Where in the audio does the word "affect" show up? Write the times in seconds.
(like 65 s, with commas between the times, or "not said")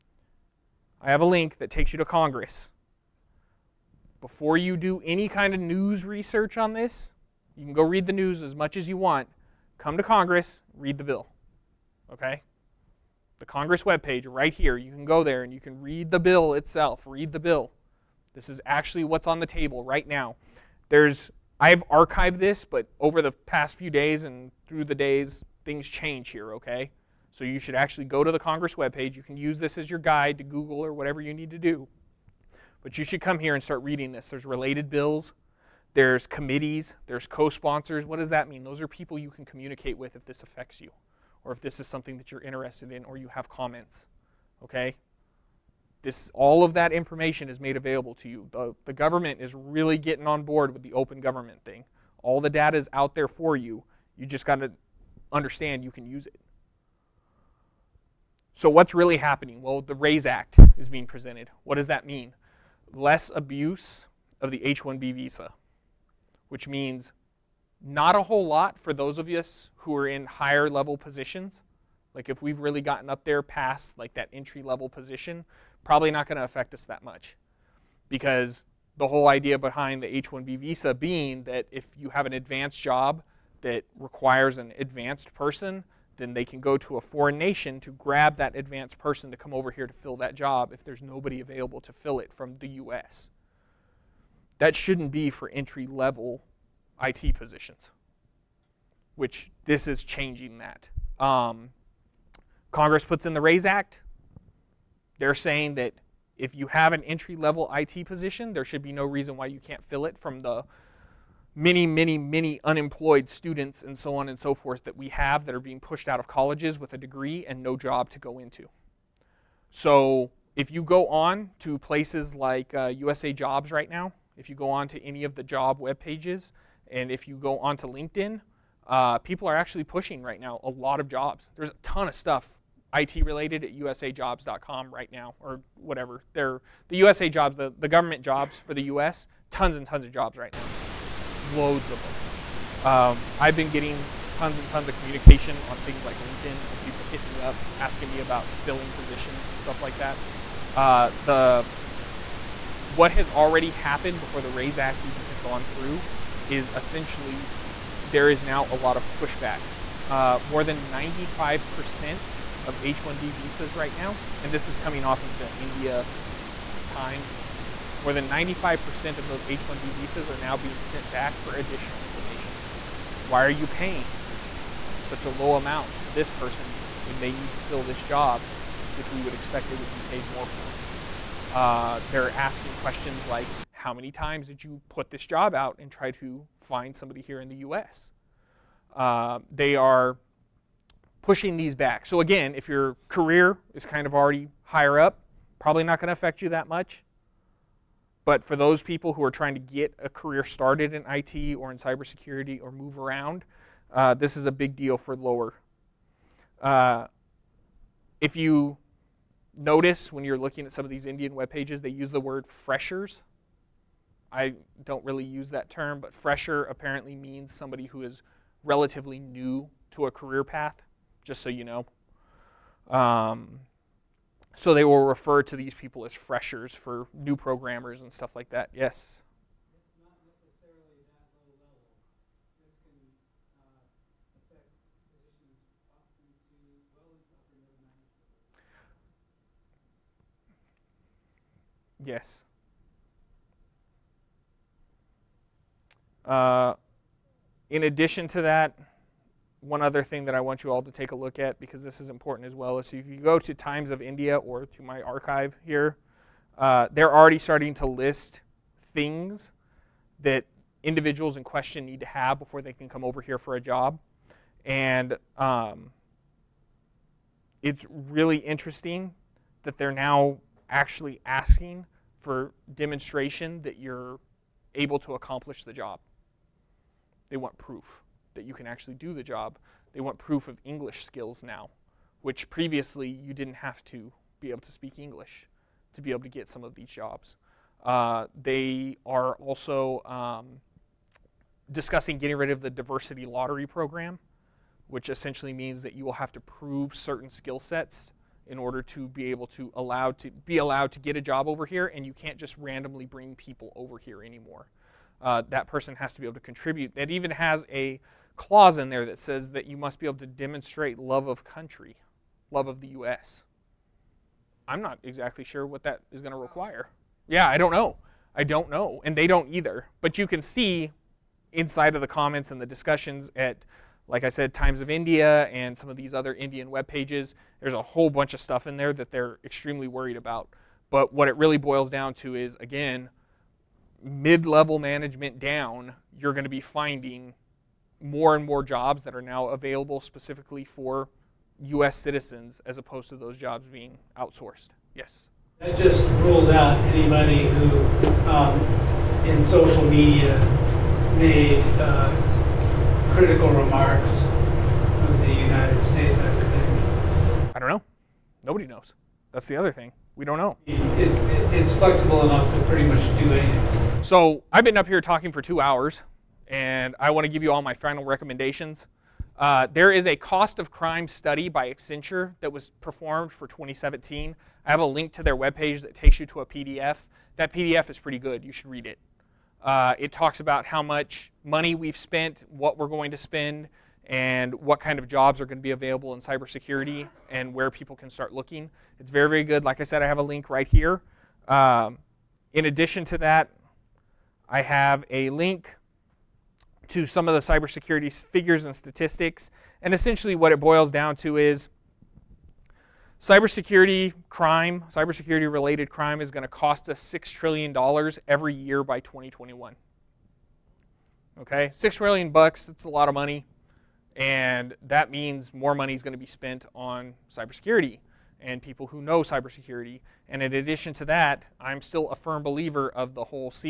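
40 s, 76 s, 196 s.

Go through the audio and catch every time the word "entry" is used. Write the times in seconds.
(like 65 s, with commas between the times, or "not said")
74 s, 95 s, 107 s.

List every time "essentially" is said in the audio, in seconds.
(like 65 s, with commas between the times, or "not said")
156 s, 295 s, 399 s.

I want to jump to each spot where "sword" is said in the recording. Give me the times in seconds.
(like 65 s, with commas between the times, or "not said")
not said.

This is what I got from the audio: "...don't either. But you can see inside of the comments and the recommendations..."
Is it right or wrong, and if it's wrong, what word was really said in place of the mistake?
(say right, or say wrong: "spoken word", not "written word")
wrong: "discussions", not "recommendations".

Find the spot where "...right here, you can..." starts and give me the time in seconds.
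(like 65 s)
14 s.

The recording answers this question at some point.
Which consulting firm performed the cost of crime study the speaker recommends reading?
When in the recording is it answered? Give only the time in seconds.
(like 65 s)
371 s.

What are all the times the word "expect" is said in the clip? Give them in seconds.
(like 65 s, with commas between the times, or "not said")
179 s.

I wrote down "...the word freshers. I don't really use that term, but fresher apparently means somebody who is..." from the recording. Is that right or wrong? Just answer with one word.
right.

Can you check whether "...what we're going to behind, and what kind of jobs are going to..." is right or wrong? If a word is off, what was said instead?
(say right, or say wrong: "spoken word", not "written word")
wrong: "spend", not "behind".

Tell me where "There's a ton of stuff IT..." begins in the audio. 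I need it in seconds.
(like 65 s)
131 s.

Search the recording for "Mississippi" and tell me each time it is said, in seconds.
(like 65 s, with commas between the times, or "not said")
not said.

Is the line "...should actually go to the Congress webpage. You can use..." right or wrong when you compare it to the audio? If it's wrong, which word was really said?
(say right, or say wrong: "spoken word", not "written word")
right.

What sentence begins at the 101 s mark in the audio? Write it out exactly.
Um, Congress puts in the RAISE Act.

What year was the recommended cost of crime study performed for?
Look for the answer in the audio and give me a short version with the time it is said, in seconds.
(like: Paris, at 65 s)
2017, at 373 s.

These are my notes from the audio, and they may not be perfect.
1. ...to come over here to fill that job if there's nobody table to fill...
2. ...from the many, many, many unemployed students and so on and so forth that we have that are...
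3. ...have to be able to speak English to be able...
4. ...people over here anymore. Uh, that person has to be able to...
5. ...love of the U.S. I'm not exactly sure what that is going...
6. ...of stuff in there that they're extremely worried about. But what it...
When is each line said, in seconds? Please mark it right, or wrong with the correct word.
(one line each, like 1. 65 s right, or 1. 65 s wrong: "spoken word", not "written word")
1. 89 s wrong: "available", not "table"
2. 110 s right
3. 283 s right
4. 303 s right
5. 312 s right
6. 328 s right.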